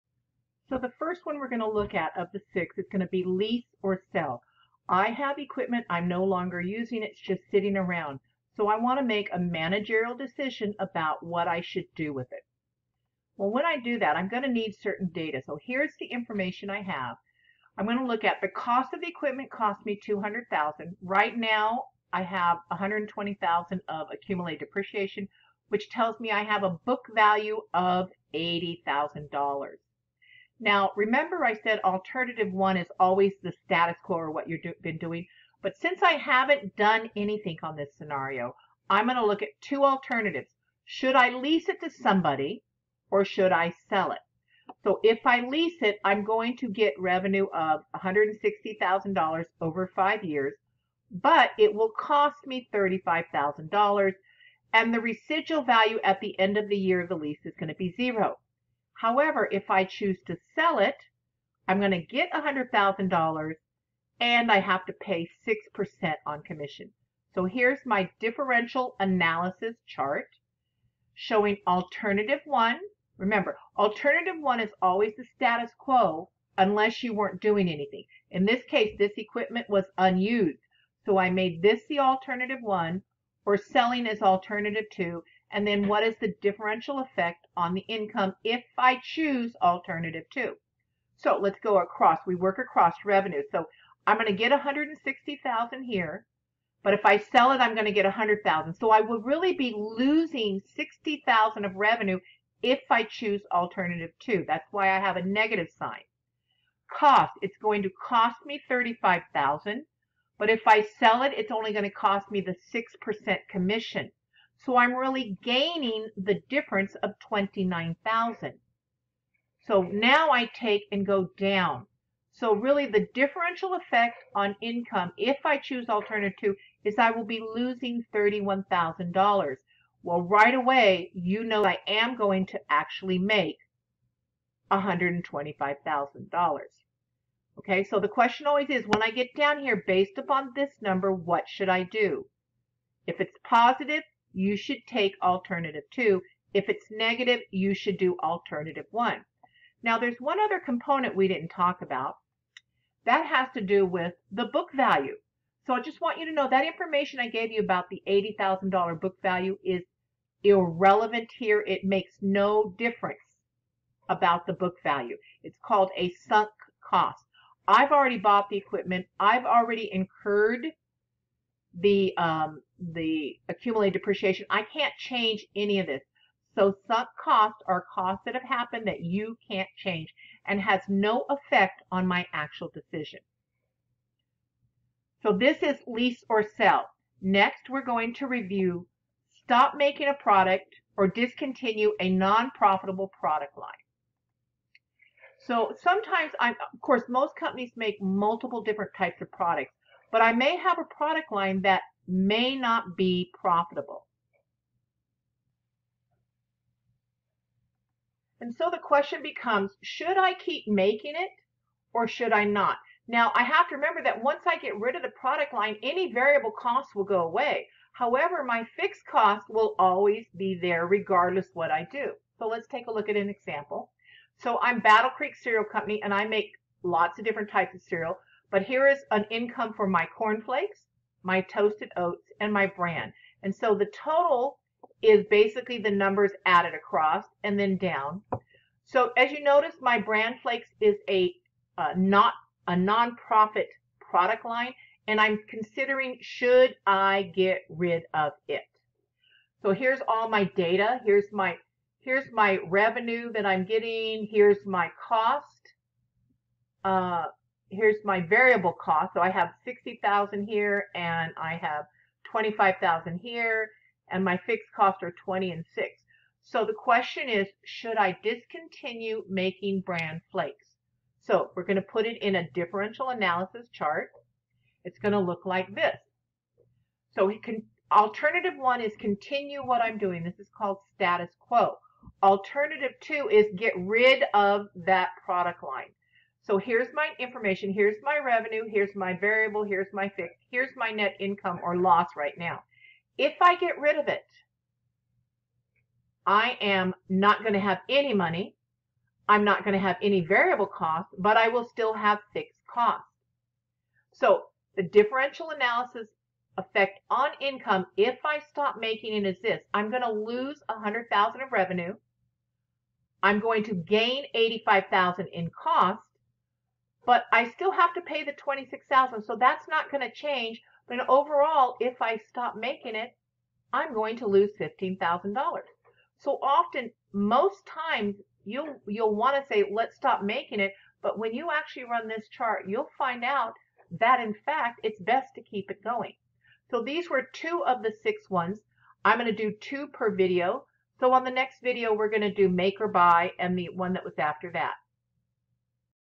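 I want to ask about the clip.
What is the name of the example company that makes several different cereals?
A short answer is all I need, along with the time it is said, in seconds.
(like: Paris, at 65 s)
Battle Creek Cereal Company, at 224 s.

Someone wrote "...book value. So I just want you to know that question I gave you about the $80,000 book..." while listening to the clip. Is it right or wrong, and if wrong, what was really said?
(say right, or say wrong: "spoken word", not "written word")
wrong: "information", not "question".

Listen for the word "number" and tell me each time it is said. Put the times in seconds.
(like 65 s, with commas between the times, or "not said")
140 s, 235 s.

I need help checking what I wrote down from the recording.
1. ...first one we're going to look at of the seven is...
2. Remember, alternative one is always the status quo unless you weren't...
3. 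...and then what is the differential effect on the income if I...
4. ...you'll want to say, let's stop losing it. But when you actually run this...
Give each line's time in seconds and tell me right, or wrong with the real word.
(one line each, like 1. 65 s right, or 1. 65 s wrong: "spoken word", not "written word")
1. 0 s wrong: "six", not "seven"
2. 73 s right
3. 85 s right
4. 328 s wrong: "making", not "losing".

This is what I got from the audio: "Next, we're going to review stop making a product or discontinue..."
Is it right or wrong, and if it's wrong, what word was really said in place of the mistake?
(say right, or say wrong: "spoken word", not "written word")
right.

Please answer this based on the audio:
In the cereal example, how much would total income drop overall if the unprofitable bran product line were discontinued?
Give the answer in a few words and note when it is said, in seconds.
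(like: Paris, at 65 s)
$15,000, at 324 s.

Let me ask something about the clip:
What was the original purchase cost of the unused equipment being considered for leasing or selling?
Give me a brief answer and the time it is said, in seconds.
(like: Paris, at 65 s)
$200,000, at 20 s.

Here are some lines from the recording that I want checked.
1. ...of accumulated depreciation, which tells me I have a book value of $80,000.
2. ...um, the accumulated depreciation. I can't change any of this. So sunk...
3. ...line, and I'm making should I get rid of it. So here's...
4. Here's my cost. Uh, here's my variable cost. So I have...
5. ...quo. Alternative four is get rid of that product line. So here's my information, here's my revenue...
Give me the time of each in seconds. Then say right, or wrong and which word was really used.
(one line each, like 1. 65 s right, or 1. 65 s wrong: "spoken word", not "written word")
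1. 23 s right
2. 172 s right
3. 244 s wrong: "considering", not "making"
4. 254 s right
5. 281 s wrong: "two", not "four".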